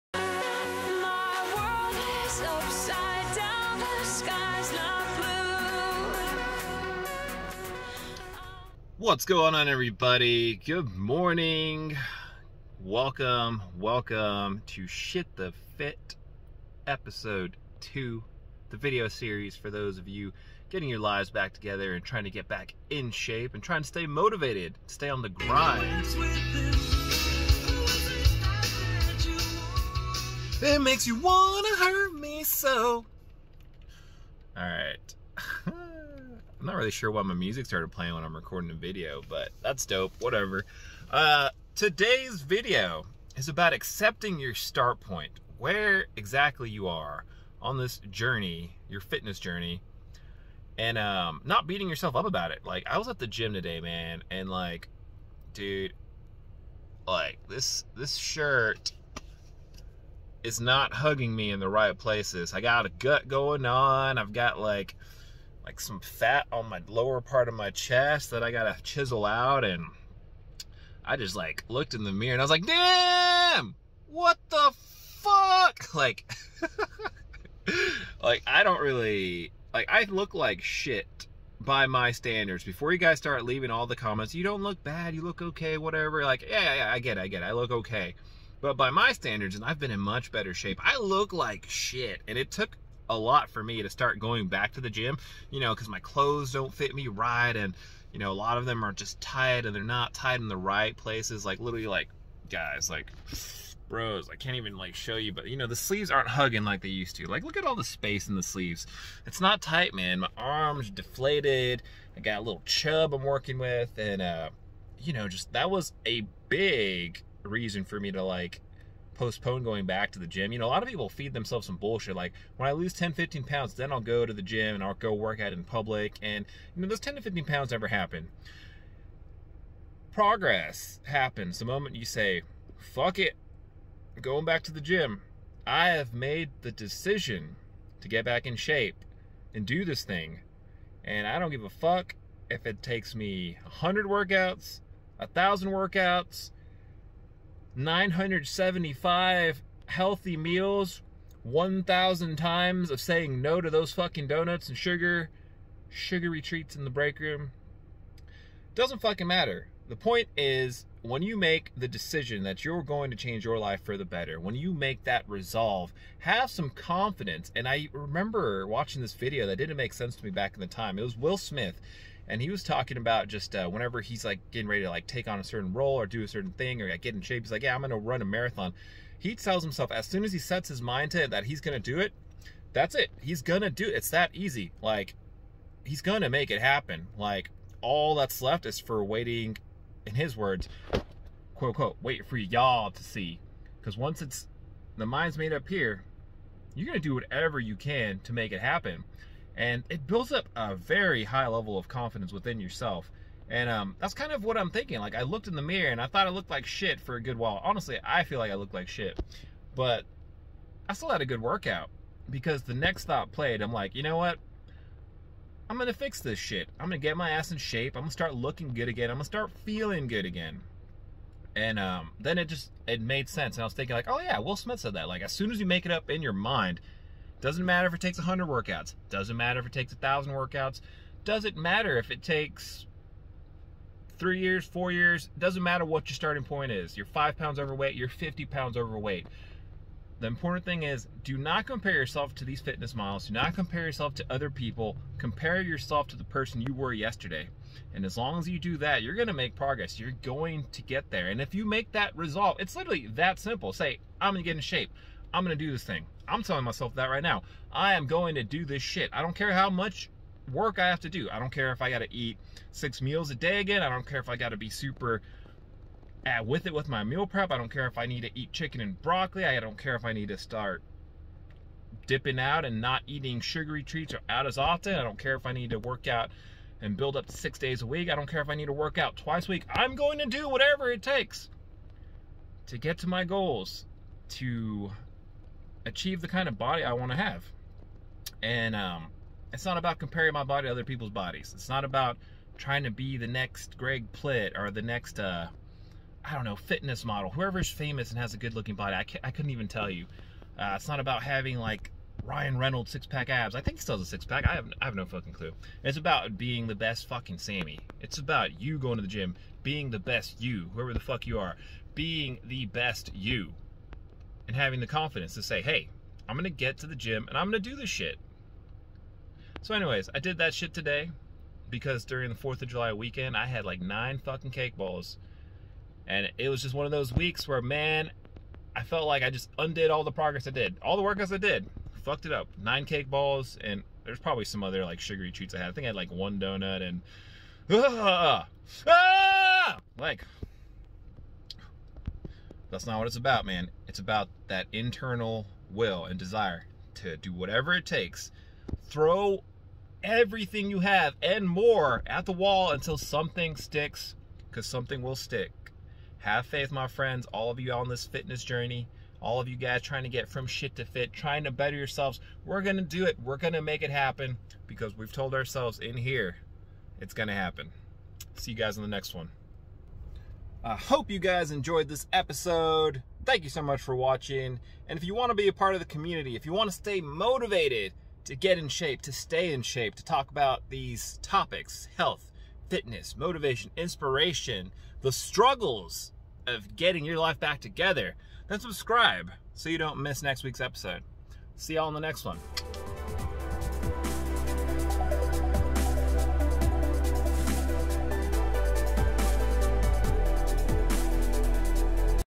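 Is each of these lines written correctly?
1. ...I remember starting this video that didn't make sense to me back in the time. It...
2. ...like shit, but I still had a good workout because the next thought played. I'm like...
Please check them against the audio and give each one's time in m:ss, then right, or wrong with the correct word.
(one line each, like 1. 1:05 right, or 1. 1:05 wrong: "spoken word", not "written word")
1. 2:47 wrong: "watching", not "starting"
2. 3:28 right.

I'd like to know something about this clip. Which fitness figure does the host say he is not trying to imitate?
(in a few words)
Greg Plitt.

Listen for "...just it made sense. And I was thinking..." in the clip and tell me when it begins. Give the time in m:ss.
3:42.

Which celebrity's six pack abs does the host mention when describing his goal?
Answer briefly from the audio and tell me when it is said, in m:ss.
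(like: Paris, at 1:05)
Ryan Reynolds, at 5:02.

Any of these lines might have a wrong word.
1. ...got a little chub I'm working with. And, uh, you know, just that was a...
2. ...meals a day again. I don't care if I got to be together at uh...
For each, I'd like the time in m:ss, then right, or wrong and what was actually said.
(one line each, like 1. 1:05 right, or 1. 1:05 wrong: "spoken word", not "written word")
1. 1:52 right
2. 4:23 wrong: "super", not "together".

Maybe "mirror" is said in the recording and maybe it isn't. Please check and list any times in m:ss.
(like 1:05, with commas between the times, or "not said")
1:12, 3:25.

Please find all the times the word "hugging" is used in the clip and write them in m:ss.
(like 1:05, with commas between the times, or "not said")
1:00, 1:46.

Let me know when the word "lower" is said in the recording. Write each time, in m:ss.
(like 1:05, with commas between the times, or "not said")
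1:06.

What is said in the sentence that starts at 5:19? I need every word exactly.
So, anyways, I did that shit today because during the 4th of July weekend, I had like nine fucking cake balls.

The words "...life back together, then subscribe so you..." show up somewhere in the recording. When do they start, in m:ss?
6:27.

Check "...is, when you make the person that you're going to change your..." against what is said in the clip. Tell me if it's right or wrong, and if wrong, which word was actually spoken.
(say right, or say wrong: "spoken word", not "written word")
wrong: "decision", not "person".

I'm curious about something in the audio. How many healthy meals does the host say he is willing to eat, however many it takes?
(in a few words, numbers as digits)
975.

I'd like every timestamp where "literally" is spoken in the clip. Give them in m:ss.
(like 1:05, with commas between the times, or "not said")
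1:41, 4:12.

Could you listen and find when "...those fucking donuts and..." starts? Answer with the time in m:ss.
2:33.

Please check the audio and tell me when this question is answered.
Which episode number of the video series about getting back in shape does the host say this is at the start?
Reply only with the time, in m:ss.
0:16.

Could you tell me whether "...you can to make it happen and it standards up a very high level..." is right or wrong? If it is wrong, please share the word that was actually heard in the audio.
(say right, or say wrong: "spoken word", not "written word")
wrong: "builds", not "standards".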